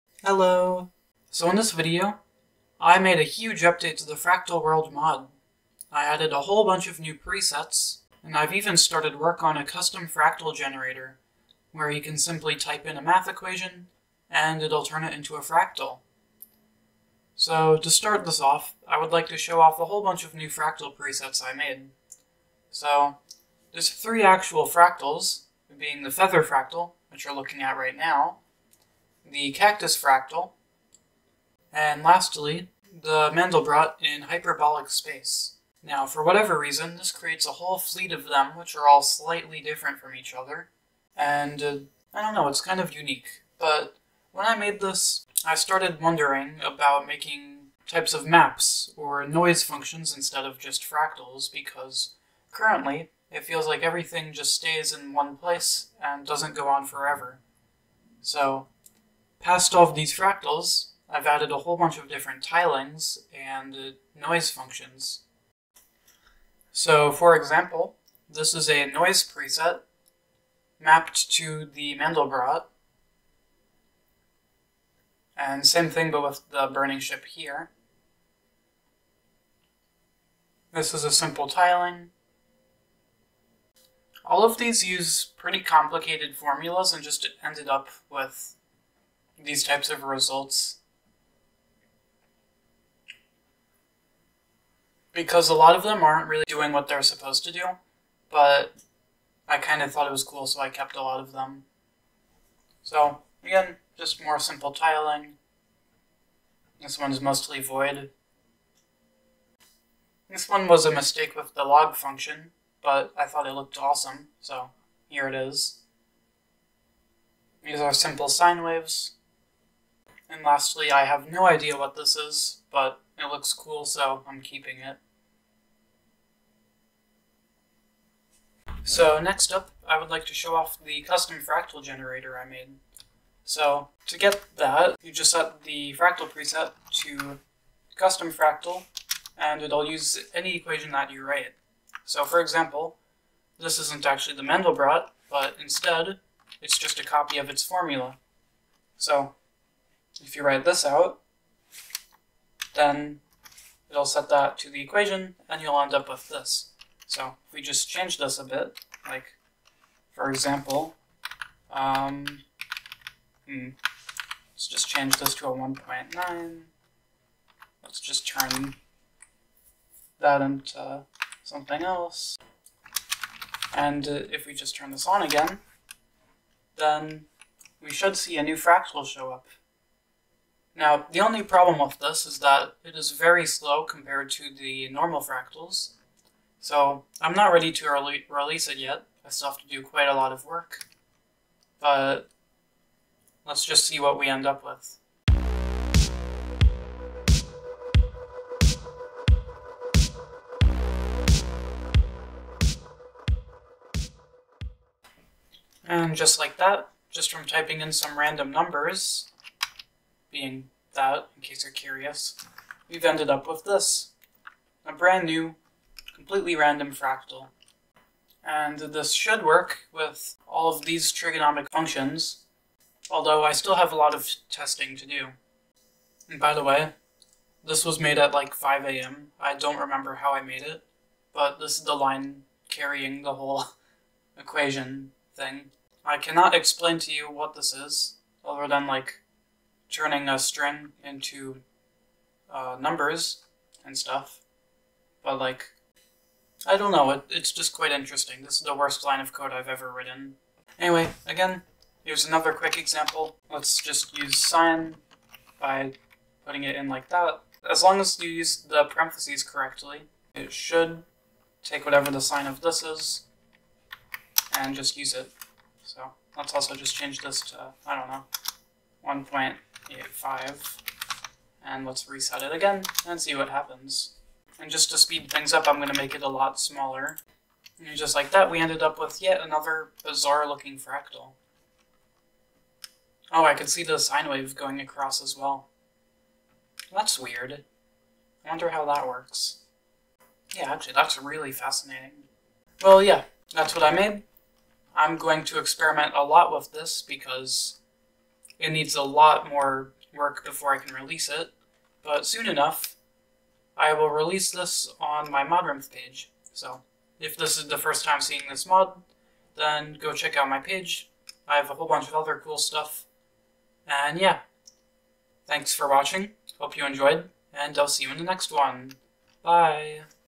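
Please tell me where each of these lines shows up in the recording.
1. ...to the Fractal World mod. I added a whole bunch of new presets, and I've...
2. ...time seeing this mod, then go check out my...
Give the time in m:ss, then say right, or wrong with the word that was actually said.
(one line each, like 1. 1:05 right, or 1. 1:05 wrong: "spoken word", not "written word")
1. 0:03 right
2. 5:08 right.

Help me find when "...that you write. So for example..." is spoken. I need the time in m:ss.
2:20.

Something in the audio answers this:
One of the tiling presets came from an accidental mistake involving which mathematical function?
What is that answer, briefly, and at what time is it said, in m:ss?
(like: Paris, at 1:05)
Log, at 1:51.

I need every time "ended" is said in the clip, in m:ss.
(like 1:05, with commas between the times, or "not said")
1:27, 3:33, 4:38.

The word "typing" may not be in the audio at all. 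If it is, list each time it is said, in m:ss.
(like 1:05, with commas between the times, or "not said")
3:27.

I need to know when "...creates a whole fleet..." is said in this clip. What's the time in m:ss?
0:37.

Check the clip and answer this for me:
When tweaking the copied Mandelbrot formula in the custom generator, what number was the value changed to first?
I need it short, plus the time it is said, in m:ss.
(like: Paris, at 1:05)
1.9, at 2:45.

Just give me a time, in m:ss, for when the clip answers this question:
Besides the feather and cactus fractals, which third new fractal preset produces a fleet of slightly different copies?
0:33.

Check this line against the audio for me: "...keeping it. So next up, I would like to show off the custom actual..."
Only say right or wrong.
wrong.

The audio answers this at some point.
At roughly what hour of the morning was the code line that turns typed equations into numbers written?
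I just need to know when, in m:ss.
3:48.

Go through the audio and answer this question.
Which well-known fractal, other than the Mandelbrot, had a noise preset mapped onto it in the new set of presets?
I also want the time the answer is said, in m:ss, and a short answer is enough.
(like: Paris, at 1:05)
Burning ship, at 1:16.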